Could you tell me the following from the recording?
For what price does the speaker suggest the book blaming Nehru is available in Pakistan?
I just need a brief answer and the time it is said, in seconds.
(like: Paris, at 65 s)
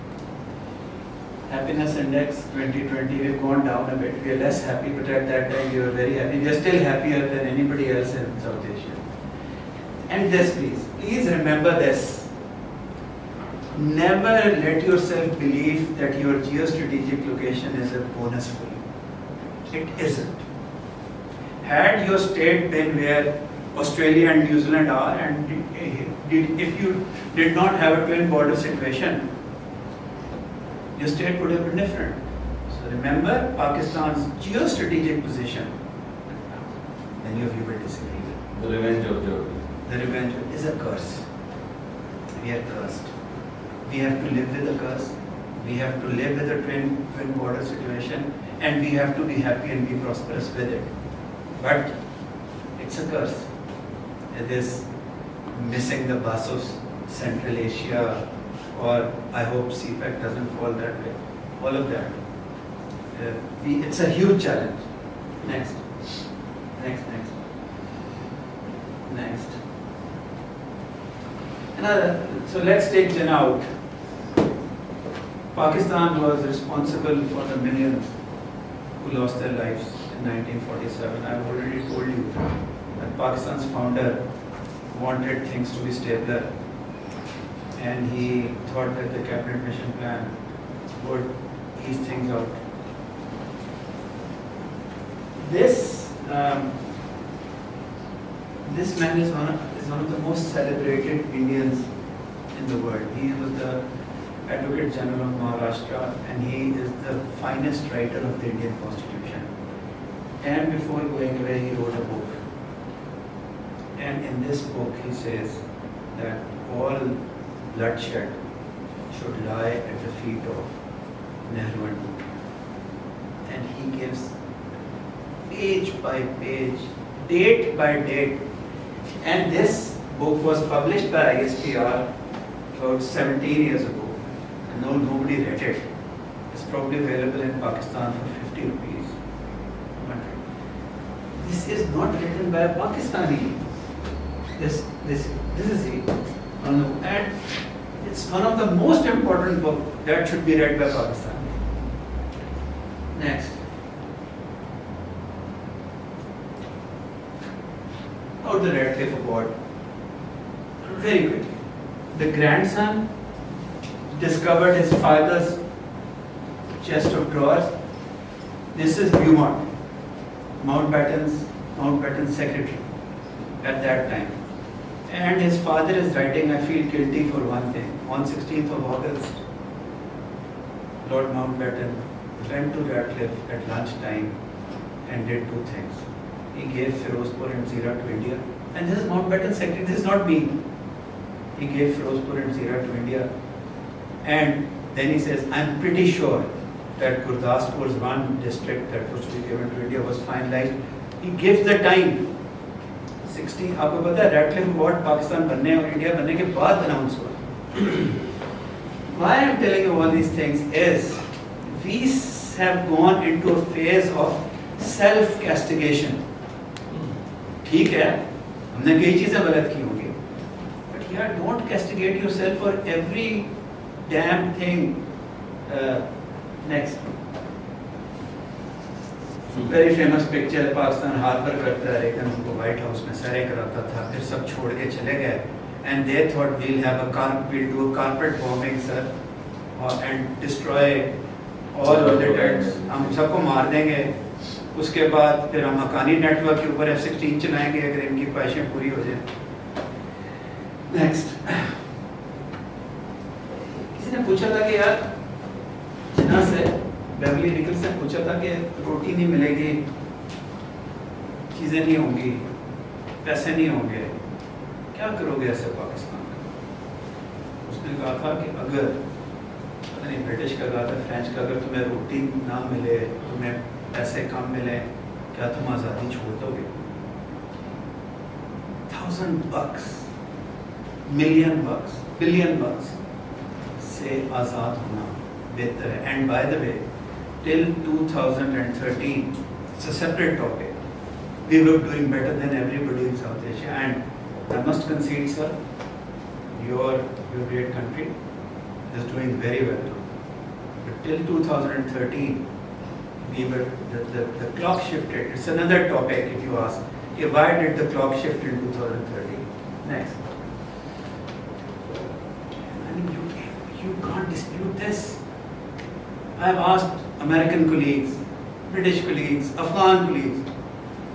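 50 rupees, at 138 s.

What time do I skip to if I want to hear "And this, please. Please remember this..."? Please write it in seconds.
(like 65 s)
10 s.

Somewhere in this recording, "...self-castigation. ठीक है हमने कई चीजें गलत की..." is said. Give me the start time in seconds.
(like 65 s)
214 s.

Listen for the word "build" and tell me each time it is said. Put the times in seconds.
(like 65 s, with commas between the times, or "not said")
not said.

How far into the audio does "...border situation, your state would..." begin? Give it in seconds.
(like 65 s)
28 s.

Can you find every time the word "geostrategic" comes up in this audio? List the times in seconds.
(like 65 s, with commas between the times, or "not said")
16 s, 34 s.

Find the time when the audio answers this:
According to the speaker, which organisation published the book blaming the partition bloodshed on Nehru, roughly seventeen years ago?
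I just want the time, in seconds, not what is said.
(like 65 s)
131 s.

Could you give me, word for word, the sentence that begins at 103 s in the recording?
He was the Advocate General of Maharashtra and he is the finest writer of the Indian Constitution.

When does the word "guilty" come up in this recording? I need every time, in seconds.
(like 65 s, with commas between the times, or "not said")
176 s.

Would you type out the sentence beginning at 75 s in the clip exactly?
Pakistan was responsible for the millions who lost their lives in 1947.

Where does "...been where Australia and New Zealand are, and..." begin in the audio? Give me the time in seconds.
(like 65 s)
22 s.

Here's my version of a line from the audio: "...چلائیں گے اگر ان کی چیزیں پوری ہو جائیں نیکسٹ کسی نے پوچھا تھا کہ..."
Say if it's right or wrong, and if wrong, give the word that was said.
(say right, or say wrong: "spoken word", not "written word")
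wrong: "خواہشیں", not "چیزیں".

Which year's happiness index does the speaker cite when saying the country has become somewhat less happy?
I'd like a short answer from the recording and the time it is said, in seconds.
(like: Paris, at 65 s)
2020, at 2 s.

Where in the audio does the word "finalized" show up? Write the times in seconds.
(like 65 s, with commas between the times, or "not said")
200 s.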